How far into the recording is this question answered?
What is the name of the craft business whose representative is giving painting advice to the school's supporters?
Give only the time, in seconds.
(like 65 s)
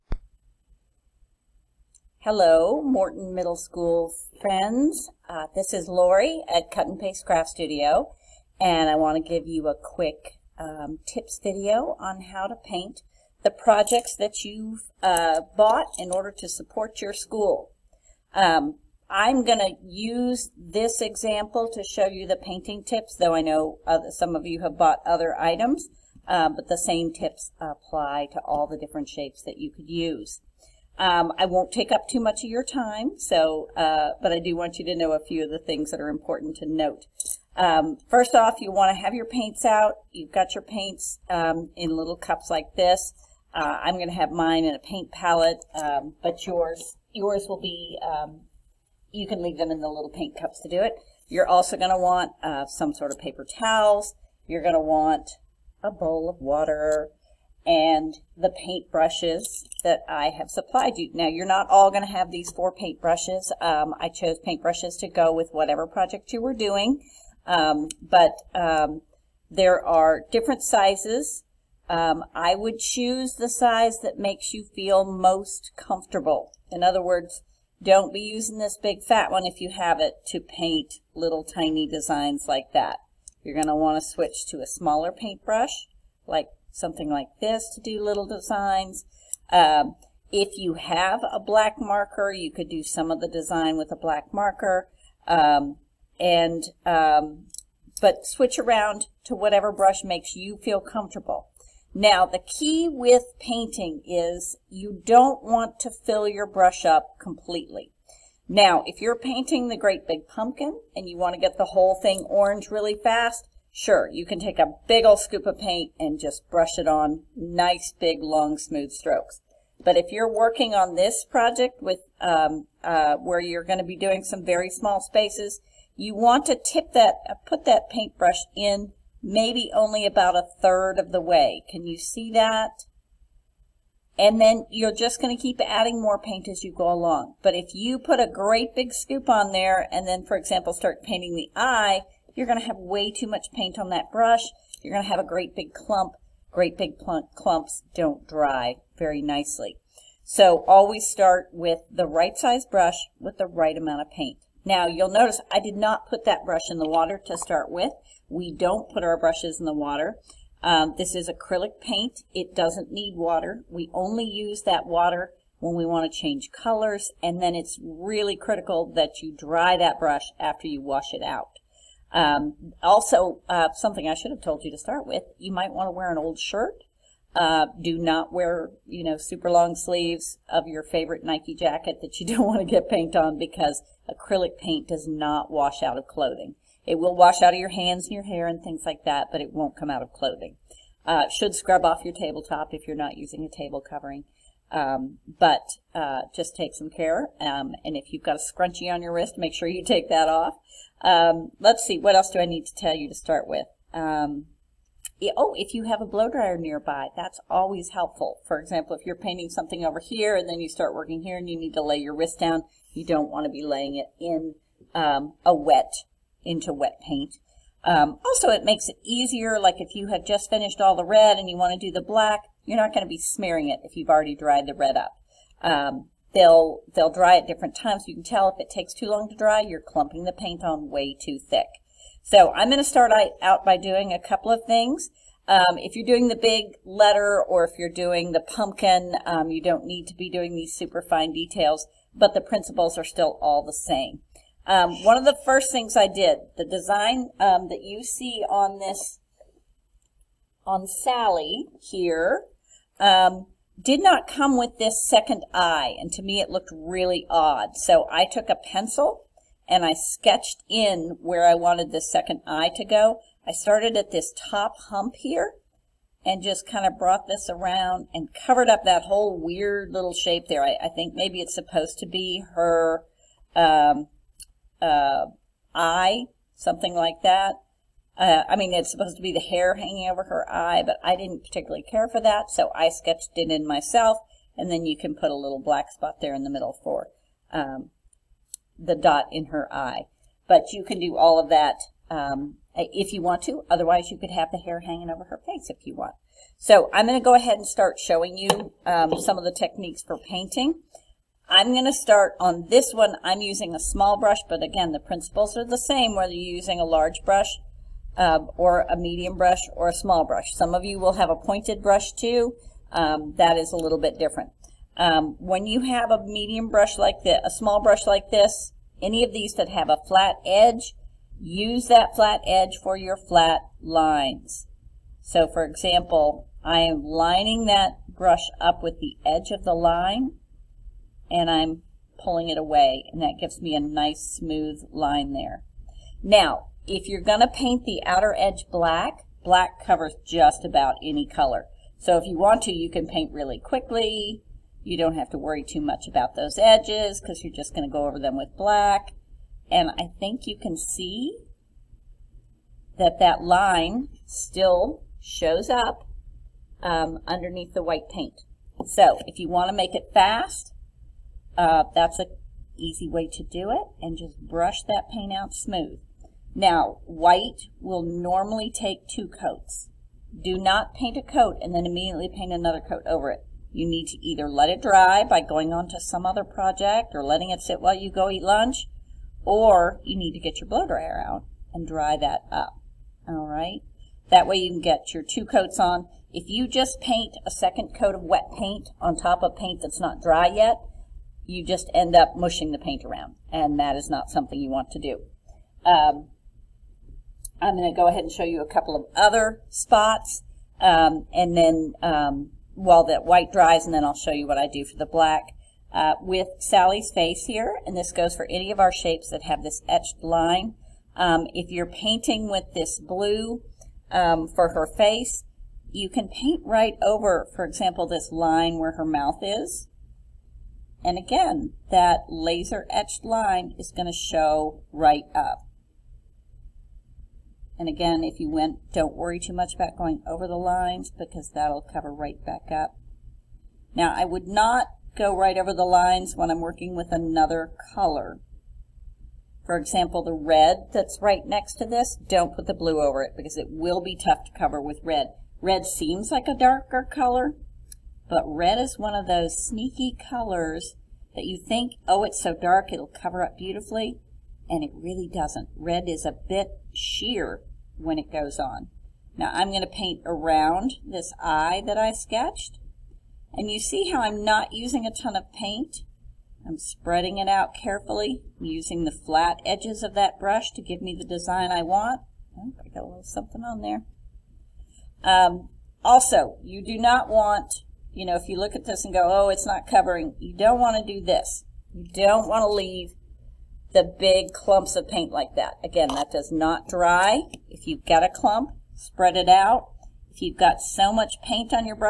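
6 s.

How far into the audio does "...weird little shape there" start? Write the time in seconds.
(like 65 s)
269 s.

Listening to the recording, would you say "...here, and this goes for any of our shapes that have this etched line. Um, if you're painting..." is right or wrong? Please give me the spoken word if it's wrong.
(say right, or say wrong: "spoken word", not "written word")
right.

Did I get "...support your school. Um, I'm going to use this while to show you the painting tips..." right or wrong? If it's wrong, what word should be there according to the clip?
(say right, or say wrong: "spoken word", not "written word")
wrong: "example", not "while".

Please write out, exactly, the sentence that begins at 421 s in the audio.
And again, that laser etched line is going to show right up.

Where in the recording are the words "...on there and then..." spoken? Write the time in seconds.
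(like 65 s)
139 s.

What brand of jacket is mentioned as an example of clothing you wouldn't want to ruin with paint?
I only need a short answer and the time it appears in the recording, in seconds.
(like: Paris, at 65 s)
Nike, at 181 s.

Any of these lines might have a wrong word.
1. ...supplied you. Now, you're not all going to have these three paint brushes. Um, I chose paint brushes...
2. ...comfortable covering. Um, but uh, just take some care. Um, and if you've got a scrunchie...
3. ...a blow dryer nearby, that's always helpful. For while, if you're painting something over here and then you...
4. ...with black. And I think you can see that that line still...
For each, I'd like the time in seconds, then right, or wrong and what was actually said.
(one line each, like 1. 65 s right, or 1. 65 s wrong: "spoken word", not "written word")
1. 60 s wrong: "four", not "three"
2. 193 s wrong: "table", not "comfortable"
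3. 206 s wrong: "example", not "while"
4. 348 s right.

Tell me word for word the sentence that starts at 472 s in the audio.
Oh, I got a little something on there.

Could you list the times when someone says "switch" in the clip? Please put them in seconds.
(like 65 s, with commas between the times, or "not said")
84 s, 98 s.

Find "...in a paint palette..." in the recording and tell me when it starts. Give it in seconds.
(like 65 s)
44 s.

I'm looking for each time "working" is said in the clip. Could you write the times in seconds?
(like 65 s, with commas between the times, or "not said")
120 s, 210 s, 436 s.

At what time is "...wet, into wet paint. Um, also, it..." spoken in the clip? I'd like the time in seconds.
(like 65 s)
215 s.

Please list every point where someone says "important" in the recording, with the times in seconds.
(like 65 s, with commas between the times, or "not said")
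36 s.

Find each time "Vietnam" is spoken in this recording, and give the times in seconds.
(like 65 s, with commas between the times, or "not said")
not said.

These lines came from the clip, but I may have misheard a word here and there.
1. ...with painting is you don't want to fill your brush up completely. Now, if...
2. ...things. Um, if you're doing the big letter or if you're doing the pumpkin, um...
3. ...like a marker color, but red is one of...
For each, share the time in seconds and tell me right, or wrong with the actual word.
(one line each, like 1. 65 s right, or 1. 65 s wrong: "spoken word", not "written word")
1. 102 s right
2. 234 s right
3. 446 s wrong: "darker", not "marker".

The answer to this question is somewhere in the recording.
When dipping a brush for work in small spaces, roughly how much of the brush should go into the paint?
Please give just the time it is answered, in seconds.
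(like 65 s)
130 s.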